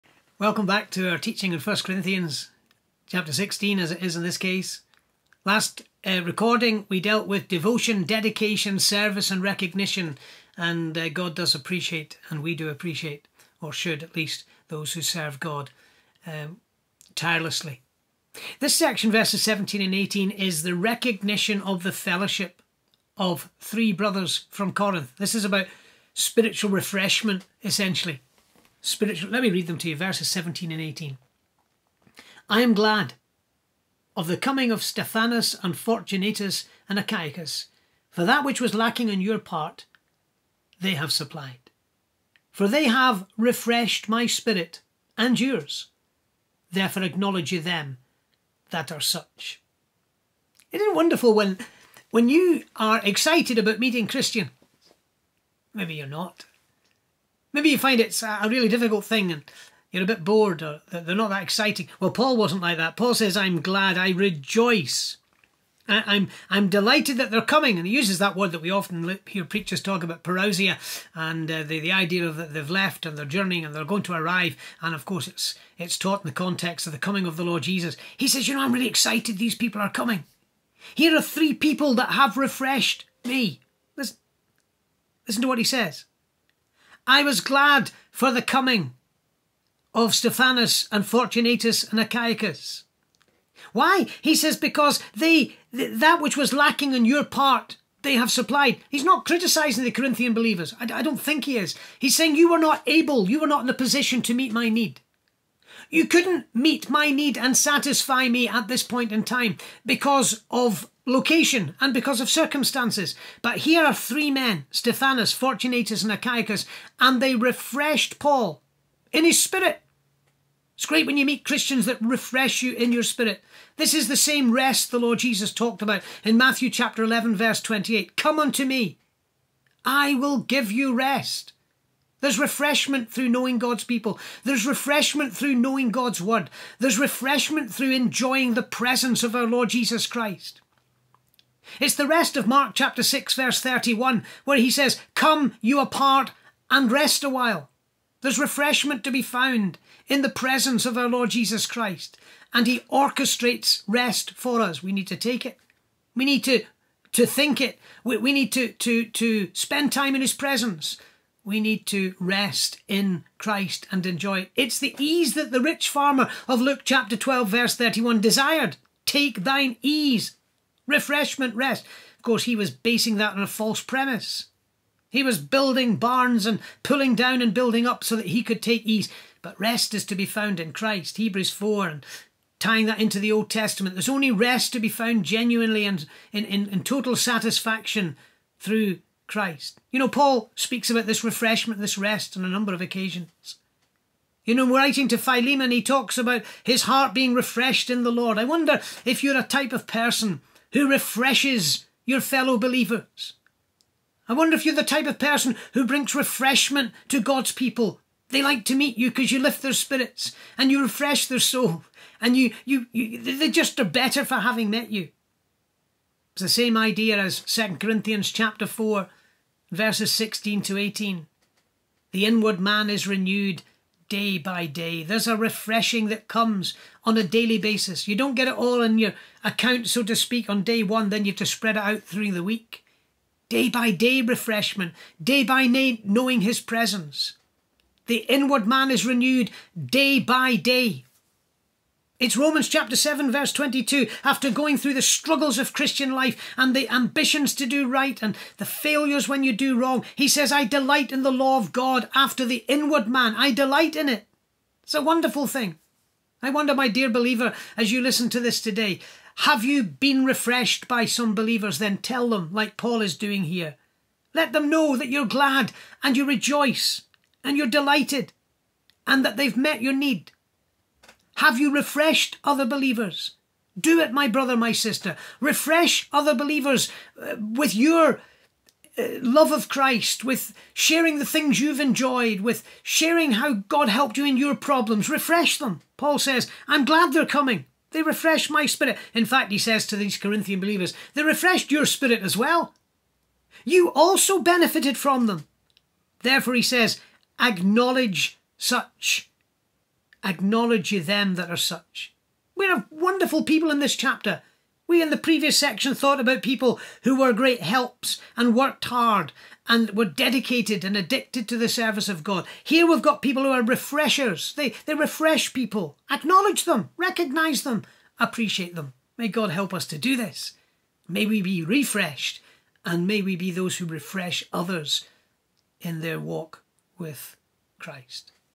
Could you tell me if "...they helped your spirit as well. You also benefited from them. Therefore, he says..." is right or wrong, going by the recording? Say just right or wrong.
wrong.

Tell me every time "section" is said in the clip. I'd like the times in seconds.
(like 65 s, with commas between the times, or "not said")
18 s, 305 s.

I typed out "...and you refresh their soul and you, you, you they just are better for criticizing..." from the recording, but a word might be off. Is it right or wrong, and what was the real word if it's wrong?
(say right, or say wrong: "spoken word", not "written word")
wrong: "having", not "criticizing".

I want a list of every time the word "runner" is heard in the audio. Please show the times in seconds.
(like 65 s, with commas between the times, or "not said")
not said.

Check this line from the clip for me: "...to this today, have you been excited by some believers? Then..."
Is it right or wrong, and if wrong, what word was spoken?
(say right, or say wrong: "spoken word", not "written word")
wrong: "refreshed", not "excited".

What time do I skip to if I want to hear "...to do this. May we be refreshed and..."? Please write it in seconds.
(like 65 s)
319 s.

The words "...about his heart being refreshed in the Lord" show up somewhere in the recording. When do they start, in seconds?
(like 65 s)
196 s.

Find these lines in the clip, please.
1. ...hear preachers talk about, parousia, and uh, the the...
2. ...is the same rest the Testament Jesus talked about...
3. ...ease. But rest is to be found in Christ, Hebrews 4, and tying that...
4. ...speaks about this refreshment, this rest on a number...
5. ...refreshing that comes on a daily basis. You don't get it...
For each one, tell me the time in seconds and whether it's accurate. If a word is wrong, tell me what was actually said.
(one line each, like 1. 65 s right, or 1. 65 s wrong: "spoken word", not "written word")
1. 69 s right
2. 123 s wrong: "Lord", not "Testament"
3. 178 s right
4. 190 s right
5. 225 s right.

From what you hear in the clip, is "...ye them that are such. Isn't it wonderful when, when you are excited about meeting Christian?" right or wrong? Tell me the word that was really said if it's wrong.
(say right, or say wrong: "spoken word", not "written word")
right.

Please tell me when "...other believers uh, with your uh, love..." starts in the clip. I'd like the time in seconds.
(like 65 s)
276 s.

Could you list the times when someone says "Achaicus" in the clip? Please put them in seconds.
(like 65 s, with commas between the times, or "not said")
36 s, 91 s, 116 s.